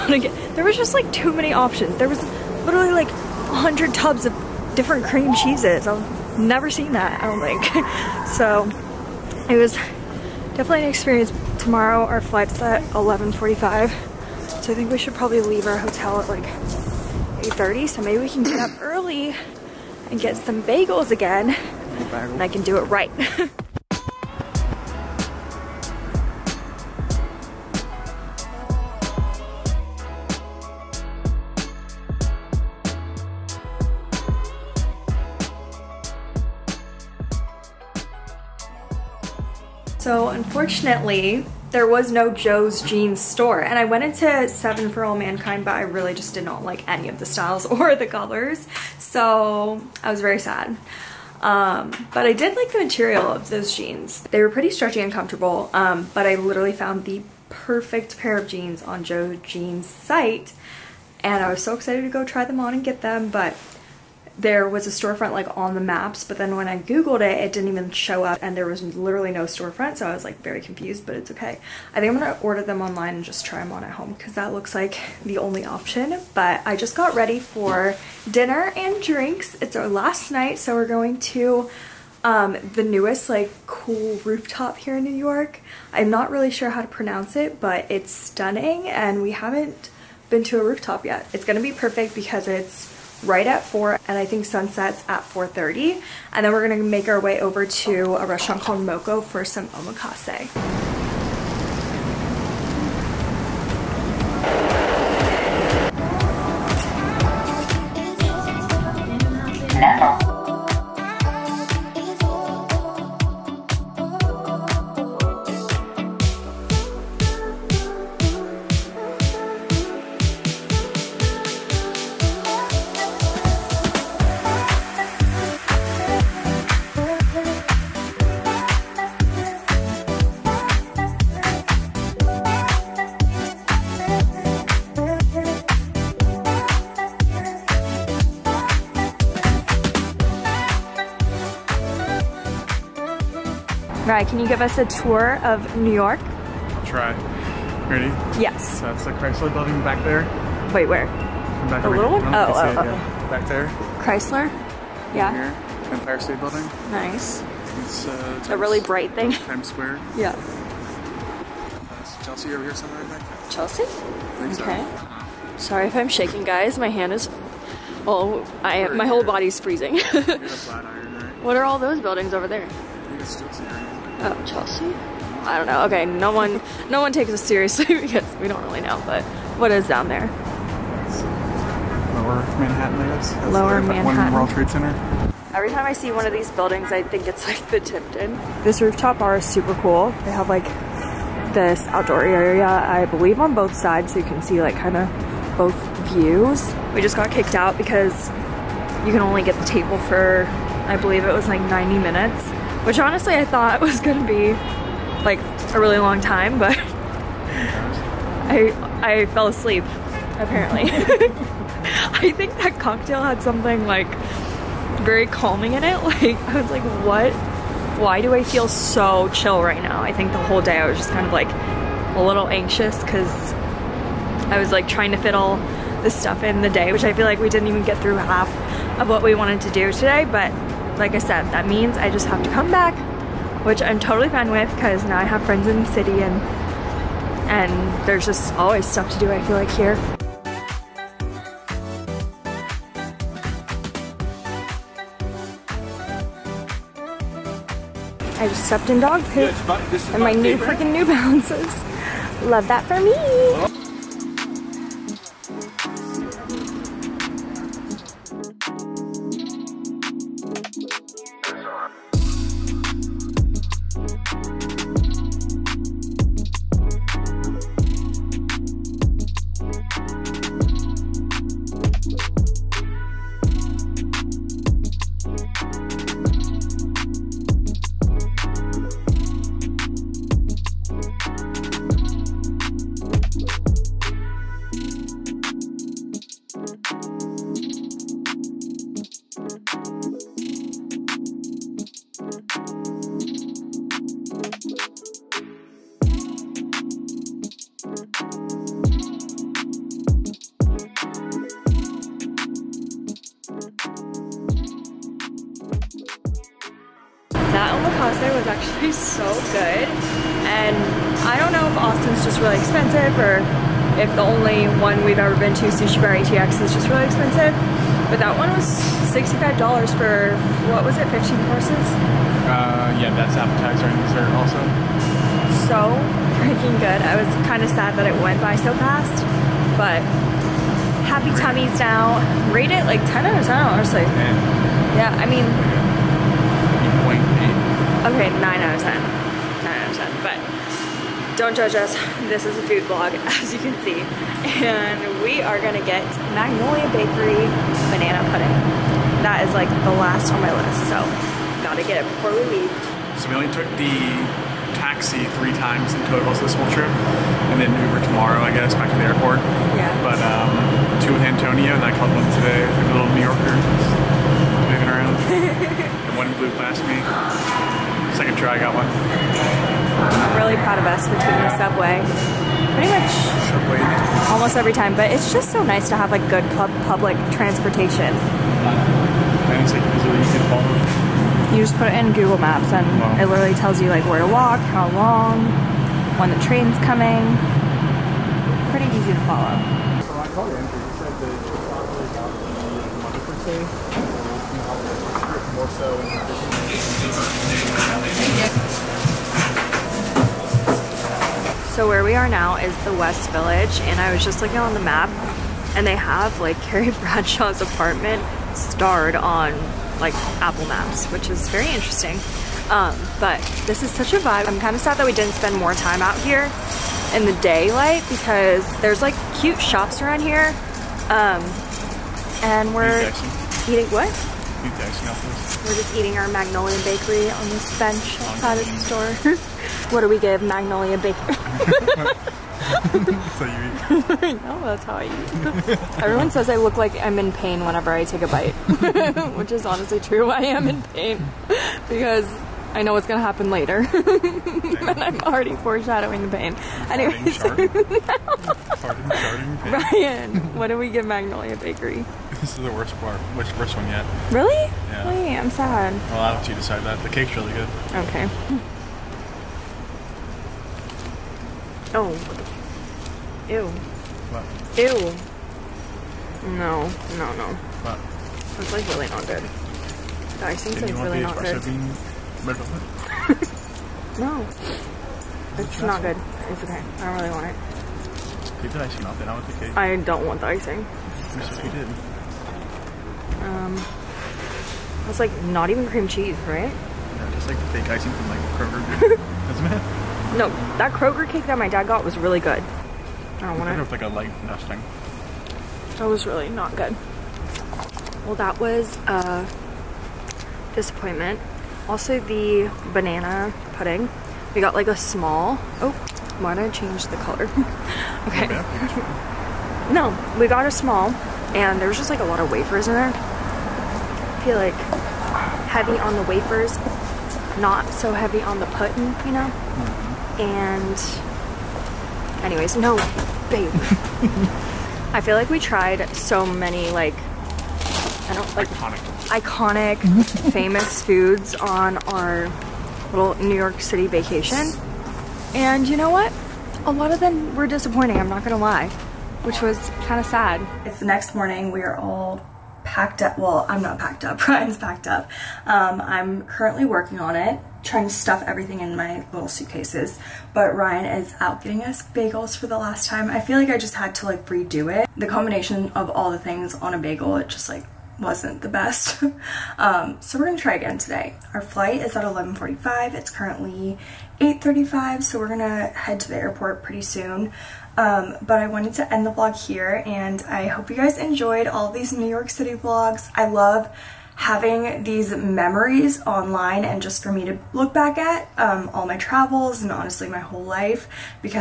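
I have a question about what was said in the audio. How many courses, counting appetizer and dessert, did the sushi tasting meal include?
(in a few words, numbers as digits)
15.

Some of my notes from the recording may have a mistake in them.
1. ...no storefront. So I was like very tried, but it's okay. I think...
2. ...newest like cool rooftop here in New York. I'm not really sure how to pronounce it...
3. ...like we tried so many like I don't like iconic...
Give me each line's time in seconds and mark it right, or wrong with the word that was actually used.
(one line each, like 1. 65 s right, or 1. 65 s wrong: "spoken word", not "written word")
1. 69 s wrong: "confused", not "tried"
2. 82 s right
3. 525 s right.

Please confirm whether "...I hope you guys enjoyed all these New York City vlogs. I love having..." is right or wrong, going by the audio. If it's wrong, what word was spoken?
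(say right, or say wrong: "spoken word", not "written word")
right.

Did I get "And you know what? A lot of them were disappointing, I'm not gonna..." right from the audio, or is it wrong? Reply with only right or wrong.
right.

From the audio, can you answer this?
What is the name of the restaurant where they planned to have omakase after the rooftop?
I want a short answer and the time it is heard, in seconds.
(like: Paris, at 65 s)
Moco, at 98 s.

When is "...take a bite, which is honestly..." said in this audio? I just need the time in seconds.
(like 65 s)
438 s.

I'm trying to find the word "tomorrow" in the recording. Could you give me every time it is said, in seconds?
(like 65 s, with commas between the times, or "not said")
11 s, 358 s.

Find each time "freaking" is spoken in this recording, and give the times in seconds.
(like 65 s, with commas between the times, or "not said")
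250 s, 326 s.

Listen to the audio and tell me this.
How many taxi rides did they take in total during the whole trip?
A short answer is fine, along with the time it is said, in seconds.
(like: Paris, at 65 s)
3, at 355 s.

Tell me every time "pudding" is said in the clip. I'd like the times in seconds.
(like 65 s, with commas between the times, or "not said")
348 s, 503 s, 518 s.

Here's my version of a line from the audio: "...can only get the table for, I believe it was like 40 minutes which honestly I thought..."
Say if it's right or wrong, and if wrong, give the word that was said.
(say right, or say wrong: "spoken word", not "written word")
wrong: "90", not "40".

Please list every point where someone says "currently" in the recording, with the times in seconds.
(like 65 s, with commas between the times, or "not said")
546 s, 563 s.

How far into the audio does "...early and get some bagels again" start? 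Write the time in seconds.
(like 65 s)
18 s.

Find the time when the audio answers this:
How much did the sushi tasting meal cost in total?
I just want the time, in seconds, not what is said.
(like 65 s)
319 s.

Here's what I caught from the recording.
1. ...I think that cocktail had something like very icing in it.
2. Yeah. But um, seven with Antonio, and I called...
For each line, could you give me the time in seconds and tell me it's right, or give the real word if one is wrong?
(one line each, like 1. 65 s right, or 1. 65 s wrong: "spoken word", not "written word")
1. 212 s wrong: "calming", not "icing"
2. 359 s wrong: "two", not "seven".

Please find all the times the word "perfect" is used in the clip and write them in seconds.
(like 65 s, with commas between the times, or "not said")
57 s, 91 s.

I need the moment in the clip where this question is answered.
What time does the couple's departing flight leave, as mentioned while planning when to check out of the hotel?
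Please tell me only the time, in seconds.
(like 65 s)
11 s.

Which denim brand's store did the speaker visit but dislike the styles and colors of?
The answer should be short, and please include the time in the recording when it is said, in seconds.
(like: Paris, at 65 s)
Seven for All Mankind, at 44 s.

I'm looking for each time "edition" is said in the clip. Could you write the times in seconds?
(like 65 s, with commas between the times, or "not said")
not said.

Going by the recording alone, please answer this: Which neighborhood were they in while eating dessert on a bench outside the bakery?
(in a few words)
West Village.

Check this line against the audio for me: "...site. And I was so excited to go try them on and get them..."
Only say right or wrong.
right.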